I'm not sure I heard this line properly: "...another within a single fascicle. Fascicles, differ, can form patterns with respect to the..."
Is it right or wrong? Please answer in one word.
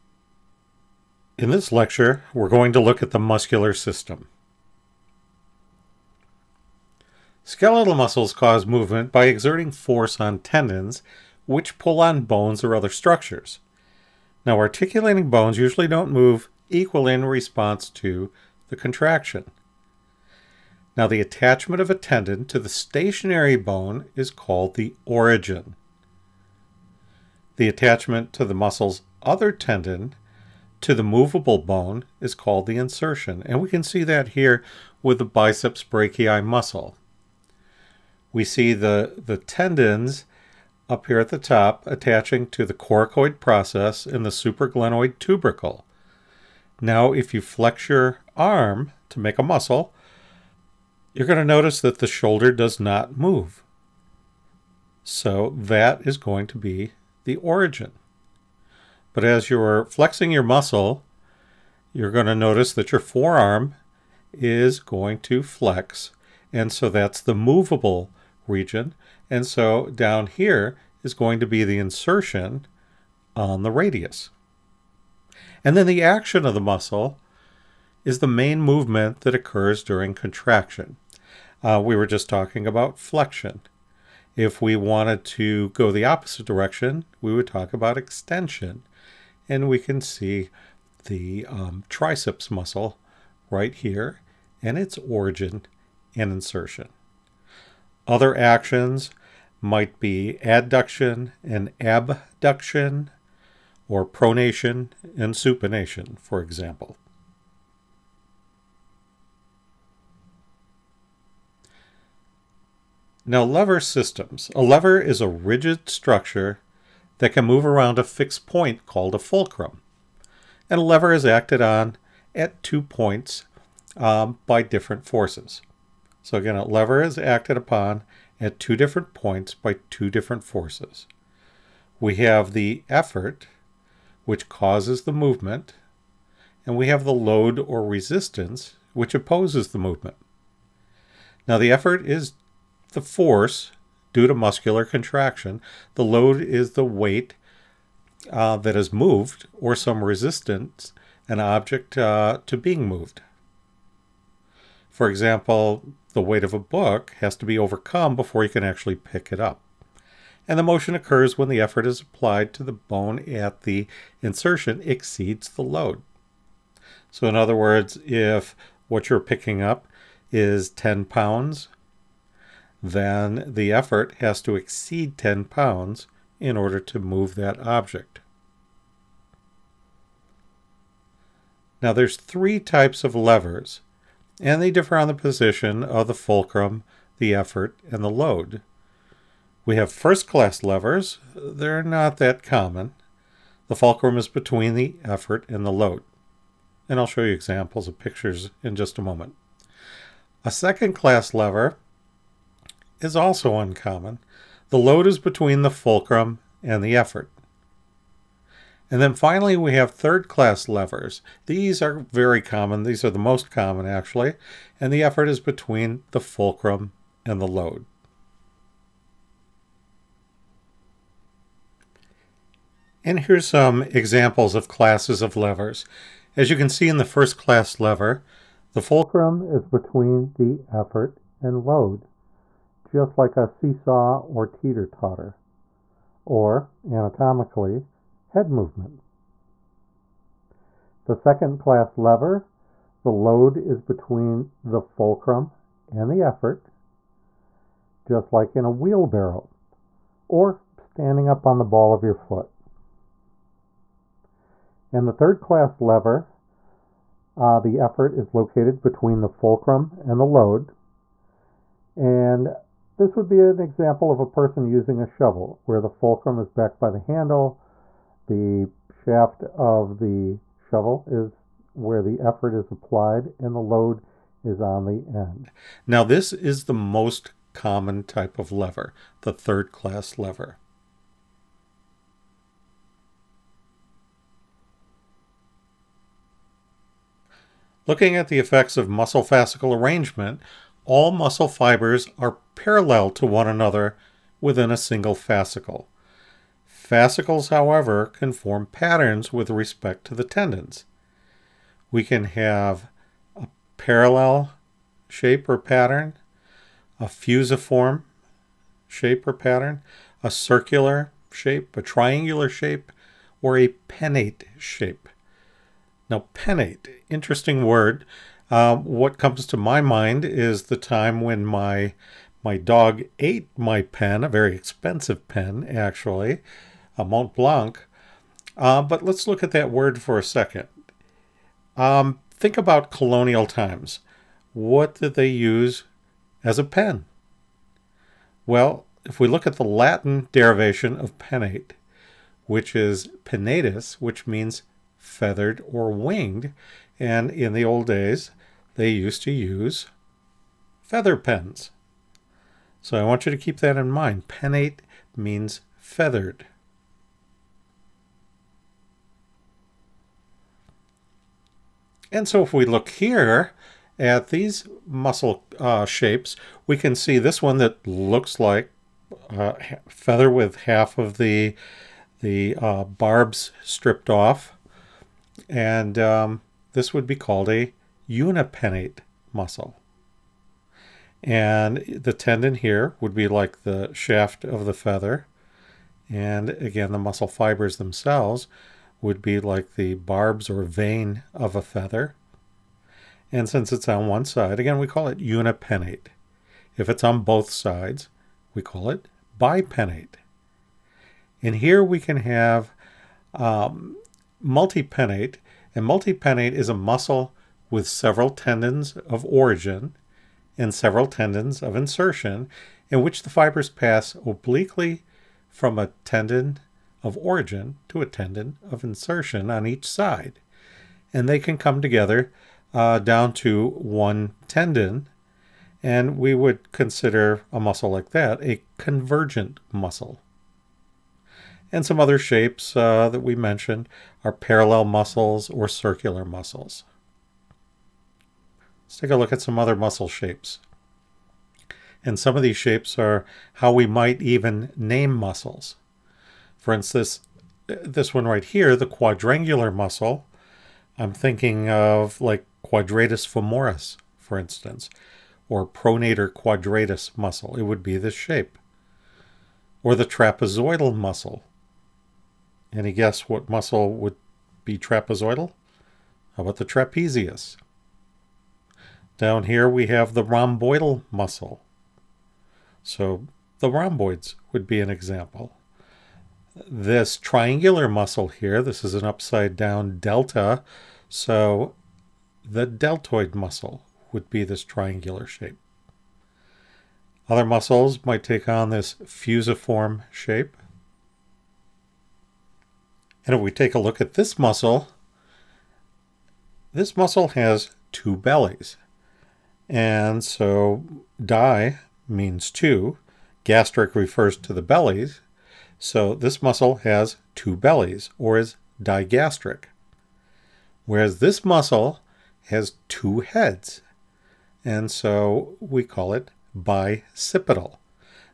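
wrong.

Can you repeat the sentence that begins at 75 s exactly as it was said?
And then the action of the muscle is the main movement that occurs during contraction.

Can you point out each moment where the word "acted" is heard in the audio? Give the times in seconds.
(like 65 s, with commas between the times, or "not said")
121 s, 127 s.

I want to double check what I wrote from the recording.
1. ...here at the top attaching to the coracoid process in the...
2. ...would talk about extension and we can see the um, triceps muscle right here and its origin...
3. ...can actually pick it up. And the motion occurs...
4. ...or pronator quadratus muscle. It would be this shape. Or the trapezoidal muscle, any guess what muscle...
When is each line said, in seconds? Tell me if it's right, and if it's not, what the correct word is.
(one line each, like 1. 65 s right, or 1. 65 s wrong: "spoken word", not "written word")
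1. 41 s right
2. 87 s right
3. 158 s right
4. 455 s right.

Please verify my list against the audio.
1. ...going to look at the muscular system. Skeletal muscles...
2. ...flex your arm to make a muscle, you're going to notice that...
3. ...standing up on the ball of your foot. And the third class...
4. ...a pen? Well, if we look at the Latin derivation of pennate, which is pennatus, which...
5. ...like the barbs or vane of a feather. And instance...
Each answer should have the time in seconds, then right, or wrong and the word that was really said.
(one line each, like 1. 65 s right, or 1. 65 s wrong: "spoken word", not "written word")
1. 2 s right
2. 47 s right
3. 250 s right
4. 336 s right
5. 389 s wrong: "since", not "instance".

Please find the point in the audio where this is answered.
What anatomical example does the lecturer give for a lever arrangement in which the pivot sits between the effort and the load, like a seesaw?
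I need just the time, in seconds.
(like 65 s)
238 s.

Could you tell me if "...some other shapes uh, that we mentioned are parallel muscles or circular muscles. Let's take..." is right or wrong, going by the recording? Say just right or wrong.
right.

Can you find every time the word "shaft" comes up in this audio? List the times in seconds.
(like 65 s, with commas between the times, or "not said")
268 s, 383 s.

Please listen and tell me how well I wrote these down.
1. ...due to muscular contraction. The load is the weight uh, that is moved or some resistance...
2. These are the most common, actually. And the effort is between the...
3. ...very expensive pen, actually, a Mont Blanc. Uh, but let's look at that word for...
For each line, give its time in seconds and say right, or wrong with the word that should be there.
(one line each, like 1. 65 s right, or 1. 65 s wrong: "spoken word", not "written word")
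1. 144 s right
2. 212 s right
3. 324 s right.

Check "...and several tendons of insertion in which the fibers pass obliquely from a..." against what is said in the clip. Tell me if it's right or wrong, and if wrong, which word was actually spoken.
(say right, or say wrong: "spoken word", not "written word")
right.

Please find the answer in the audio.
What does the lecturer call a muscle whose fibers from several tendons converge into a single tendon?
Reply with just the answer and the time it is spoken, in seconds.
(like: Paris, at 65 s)
convergent muscle, at 428 s.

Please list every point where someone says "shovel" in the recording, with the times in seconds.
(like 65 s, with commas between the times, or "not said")
265 s, 270 s.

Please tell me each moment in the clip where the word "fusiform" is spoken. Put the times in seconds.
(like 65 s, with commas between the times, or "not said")
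307 s, 489 s.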